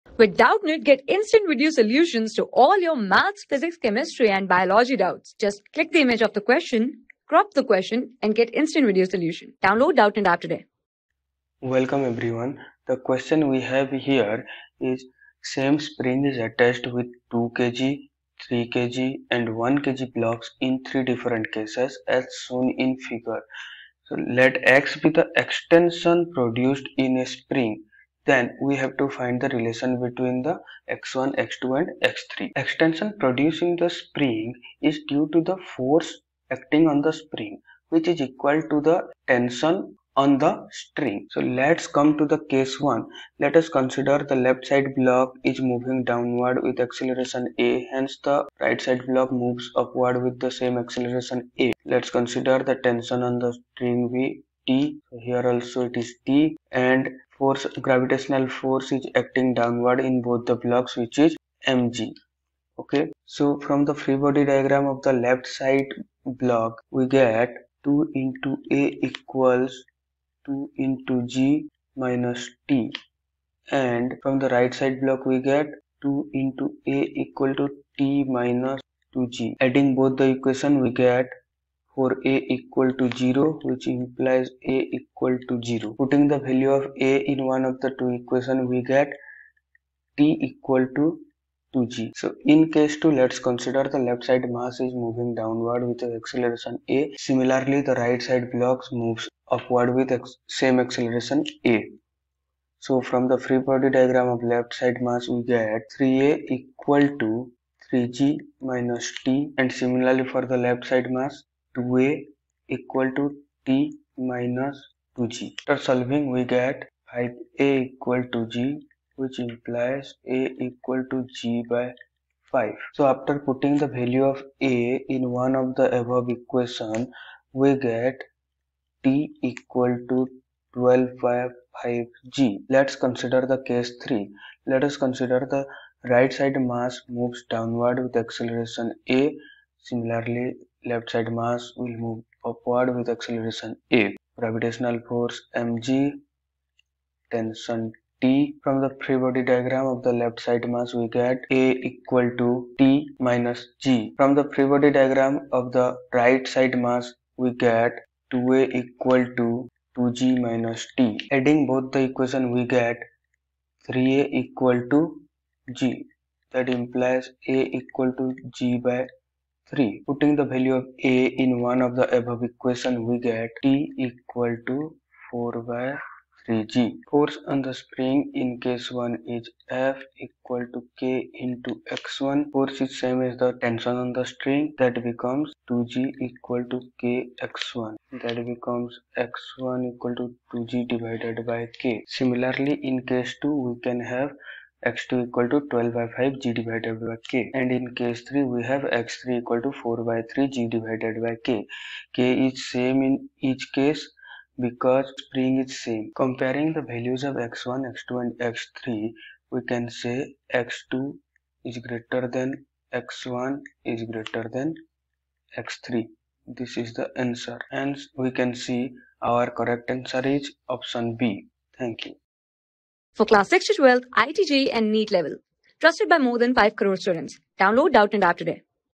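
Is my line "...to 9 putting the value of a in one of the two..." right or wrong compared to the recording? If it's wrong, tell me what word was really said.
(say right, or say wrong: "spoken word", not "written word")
wrong: "0", not "9".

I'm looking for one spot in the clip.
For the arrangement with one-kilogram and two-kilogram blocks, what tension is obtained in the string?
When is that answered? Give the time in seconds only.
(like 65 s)
173 s.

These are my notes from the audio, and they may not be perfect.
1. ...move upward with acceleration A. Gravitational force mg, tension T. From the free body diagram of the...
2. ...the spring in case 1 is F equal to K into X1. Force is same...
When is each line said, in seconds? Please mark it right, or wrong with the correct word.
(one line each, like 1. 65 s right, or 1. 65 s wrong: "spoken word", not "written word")
1. 142 s right
2. 177 s right.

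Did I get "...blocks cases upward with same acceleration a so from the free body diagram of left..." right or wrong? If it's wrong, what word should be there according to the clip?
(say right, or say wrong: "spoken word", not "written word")
wrong: "moves", not "cases".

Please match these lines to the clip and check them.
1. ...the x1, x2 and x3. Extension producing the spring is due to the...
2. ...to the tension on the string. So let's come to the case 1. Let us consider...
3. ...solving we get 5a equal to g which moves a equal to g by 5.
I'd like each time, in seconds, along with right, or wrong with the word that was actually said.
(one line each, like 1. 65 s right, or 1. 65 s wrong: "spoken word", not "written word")
1. 30 s right
2. 38 s right
3. 115 s wrong: "implies", not "moves".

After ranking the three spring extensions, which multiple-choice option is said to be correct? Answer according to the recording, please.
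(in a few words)
Option B.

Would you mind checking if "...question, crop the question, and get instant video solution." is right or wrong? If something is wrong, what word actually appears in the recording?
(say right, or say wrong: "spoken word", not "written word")
right.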